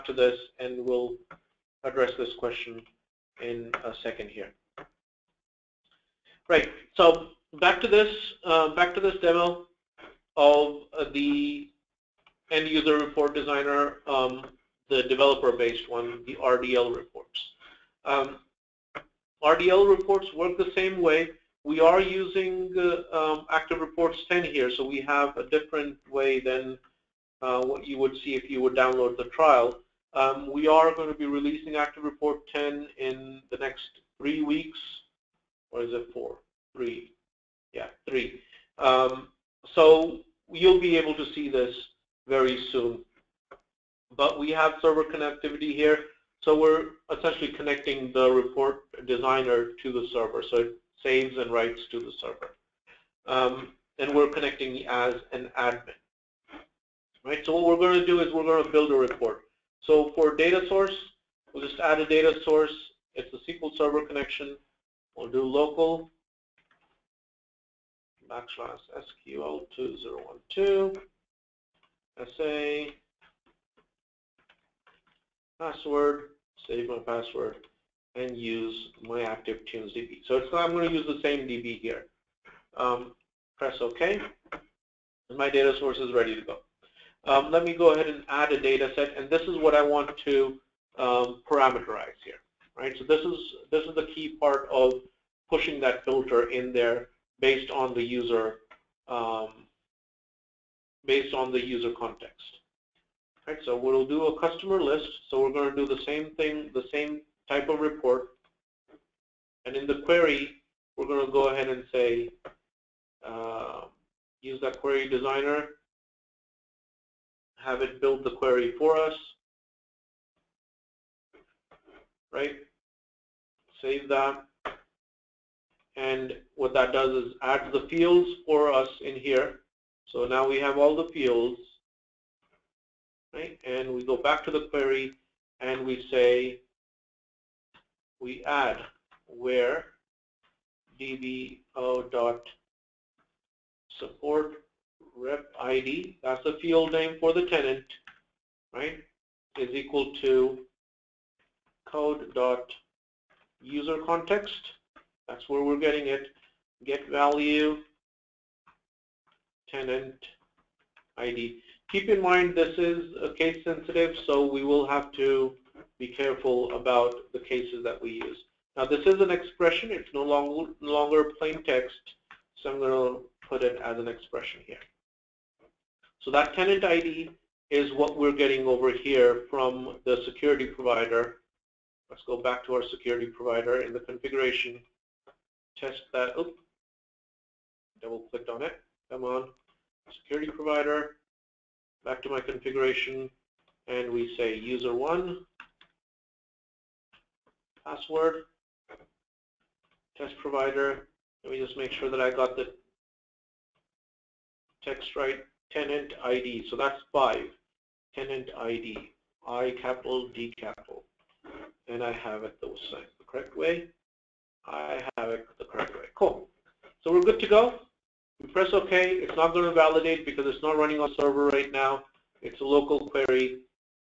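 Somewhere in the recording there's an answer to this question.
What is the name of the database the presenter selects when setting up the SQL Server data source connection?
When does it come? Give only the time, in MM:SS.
01:19.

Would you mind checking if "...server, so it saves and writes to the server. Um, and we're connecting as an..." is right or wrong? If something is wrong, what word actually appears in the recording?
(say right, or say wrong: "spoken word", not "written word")
right.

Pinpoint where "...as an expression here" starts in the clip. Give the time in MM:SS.
02:53.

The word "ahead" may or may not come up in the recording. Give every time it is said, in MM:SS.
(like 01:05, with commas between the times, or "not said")
01:27, 01:51.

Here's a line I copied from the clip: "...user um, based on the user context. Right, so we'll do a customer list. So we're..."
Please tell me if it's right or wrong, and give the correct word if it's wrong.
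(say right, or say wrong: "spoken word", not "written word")
right.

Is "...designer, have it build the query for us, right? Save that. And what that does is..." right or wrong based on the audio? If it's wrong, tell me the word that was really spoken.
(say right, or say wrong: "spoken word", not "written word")
right.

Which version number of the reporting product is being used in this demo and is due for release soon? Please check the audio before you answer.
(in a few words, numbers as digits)
Active Reports 10.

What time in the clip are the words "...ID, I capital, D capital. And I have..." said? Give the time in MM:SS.
03:28.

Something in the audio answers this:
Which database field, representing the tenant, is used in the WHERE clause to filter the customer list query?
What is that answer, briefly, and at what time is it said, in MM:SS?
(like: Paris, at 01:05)
support rep id, at 02:23.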